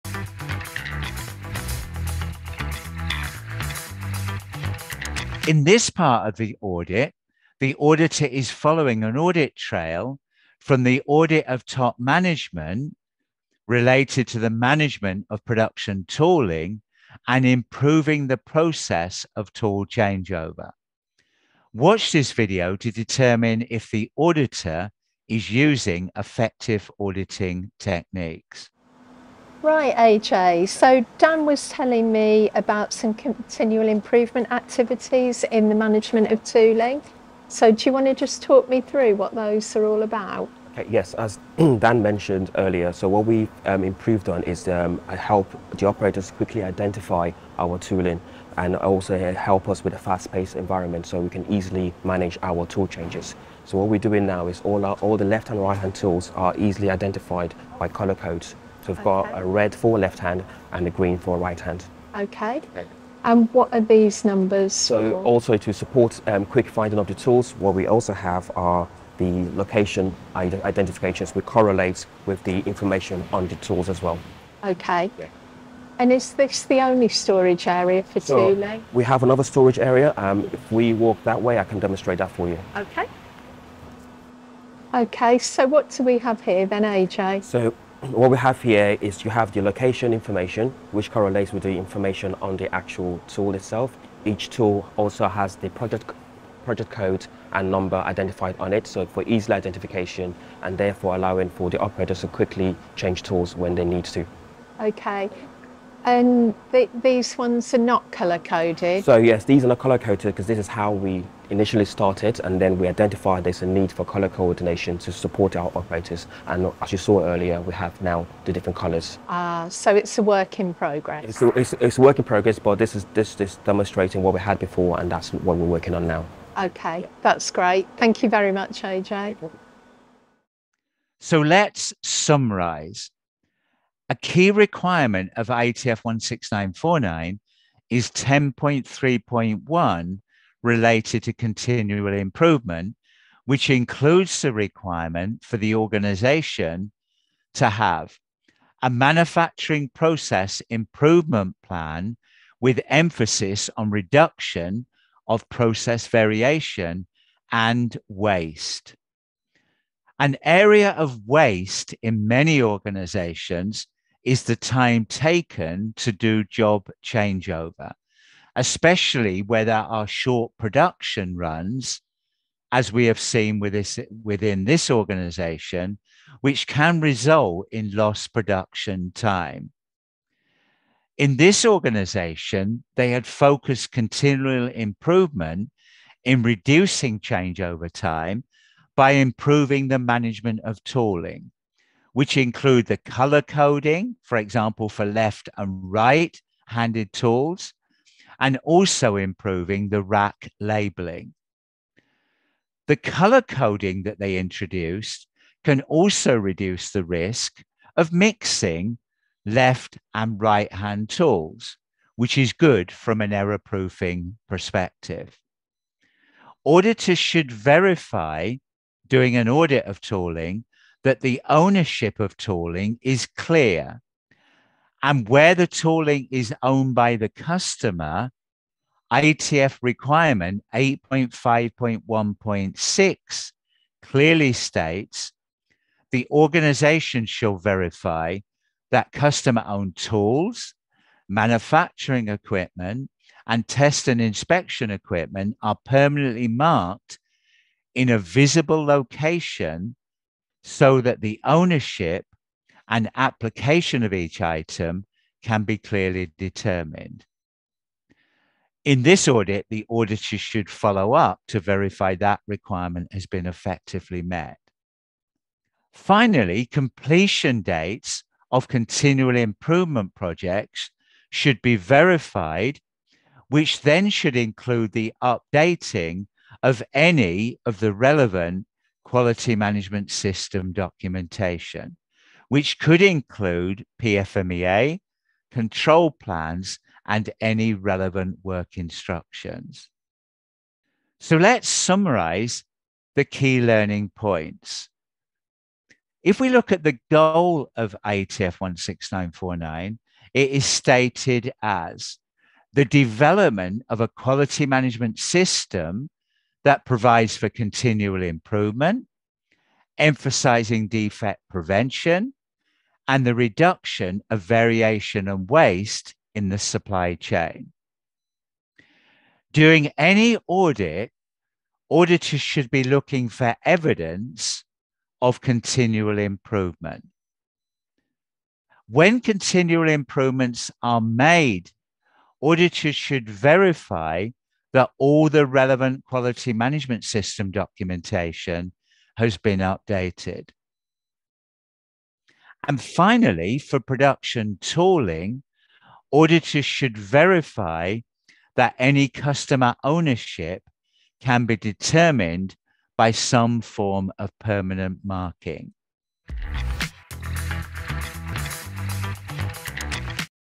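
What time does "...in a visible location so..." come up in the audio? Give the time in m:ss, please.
4:07.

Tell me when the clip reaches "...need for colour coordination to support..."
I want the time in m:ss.
1:53.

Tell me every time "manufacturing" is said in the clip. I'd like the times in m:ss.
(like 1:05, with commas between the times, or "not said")
2:28, 4:01.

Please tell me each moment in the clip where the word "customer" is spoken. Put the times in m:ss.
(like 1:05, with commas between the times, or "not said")
3:47, 3:59, 5:49.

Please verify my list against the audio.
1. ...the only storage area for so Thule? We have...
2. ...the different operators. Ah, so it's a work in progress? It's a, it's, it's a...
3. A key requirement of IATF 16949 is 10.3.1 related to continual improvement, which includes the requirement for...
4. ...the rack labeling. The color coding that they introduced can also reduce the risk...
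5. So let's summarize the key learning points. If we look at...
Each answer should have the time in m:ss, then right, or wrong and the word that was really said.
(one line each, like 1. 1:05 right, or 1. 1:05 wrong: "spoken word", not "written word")
1. 1:16 right
2. 1:58 wrong: "colours", not "operators"
3. 2:14 right
4. 3:19 right
5. 4:51 right.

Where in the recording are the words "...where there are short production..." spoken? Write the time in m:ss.
2:49.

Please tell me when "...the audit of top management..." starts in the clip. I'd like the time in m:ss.
0:10.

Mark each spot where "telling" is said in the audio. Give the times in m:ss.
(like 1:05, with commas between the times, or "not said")
0:31.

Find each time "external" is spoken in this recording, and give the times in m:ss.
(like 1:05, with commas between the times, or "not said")
not said.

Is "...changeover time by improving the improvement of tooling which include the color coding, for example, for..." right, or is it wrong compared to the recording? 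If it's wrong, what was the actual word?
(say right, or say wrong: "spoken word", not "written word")
wrong: "management", not "improvement".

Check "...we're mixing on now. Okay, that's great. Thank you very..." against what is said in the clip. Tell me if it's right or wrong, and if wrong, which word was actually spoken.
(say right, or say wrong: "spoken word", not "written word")
wrong: "working", not "mixing".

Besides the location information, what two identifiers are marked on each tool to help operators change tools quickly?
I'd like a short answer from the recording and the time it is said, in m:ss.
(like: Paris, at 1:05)
Project code and number, at 1:36.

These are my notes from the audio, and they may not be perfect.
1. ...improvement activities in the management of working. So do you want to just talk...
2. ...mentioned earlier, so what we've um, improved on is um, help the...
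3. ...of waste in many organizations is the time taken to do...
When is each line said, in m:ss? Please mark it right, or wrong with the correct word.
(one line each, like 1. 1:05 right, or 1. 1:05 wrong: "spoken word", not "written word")
1. 0:33 wrong: "tooling", not "working"
2. 0:42 right
3. 2:40 right.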